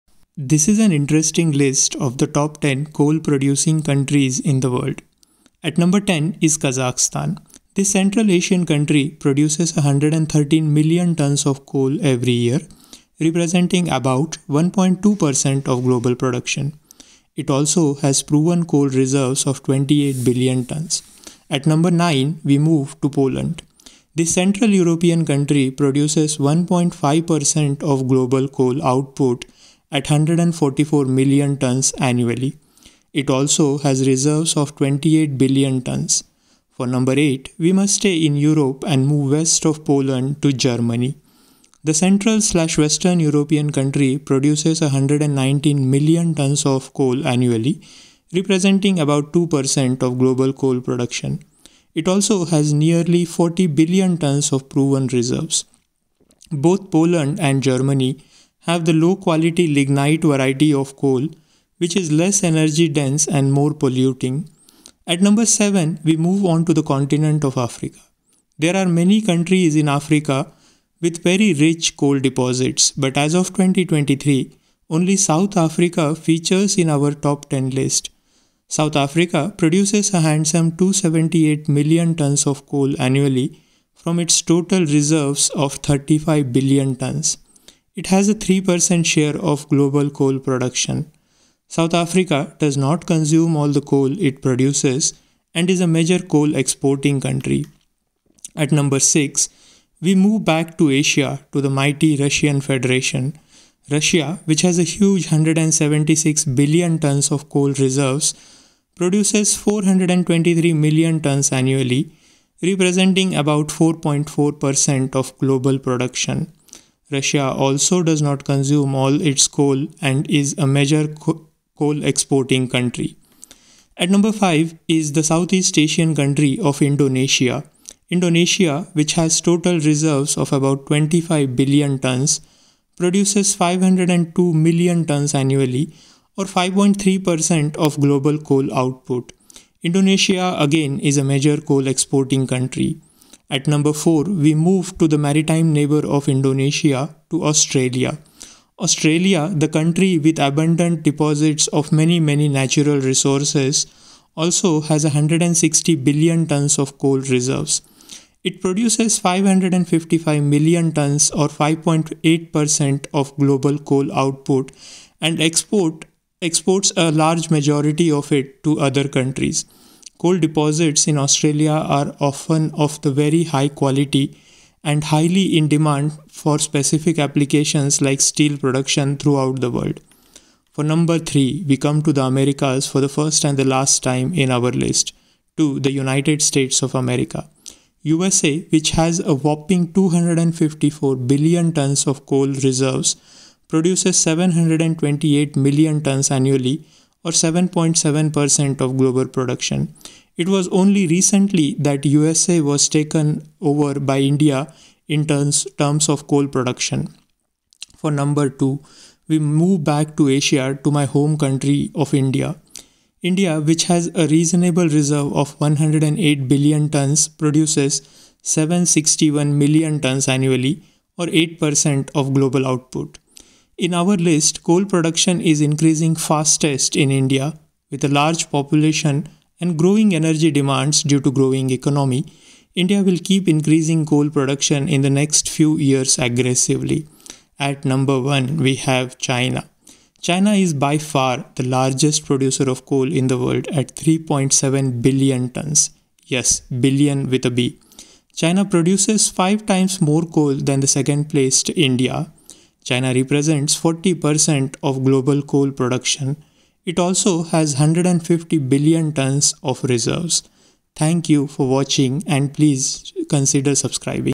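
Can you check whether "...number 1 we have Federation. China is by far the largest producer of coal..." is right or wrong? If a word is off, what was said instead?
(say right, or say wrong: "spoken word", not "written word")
wrong: "China", not "Federation".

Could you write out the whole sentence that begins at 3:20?
It was only recently that USA was taken over by India in terms, terms of coal production.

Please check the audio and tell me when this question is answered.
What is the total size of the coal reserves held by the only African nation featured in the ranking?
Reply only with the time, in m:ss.
1:25.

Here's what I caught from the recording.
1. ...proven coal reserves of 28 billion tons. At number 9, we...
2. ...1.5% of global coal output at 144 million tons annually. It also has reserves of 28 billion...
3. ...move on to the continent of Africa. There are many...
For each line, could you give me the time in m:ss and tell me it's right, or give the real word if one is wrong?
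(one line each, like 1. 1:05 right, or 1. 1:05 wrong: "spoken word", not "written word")
1. 0:18 right
2. 0:26 right
3. 1:06 right.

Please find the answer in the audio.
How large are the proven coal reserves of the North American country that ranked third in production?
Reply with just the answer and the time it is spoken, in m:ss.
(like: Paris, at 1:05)
254 billion tons, at 3:09.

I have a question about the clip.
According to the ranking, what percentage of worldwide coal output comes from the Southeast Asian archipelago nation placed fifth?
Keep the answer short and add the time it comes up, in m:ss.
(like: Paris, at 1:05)
5.3%, at 2:16.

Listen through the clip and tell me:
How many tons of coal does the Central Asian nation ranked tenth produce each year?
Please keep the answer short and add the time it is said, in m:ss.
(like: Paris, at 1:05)
113 million tons, at 0:09.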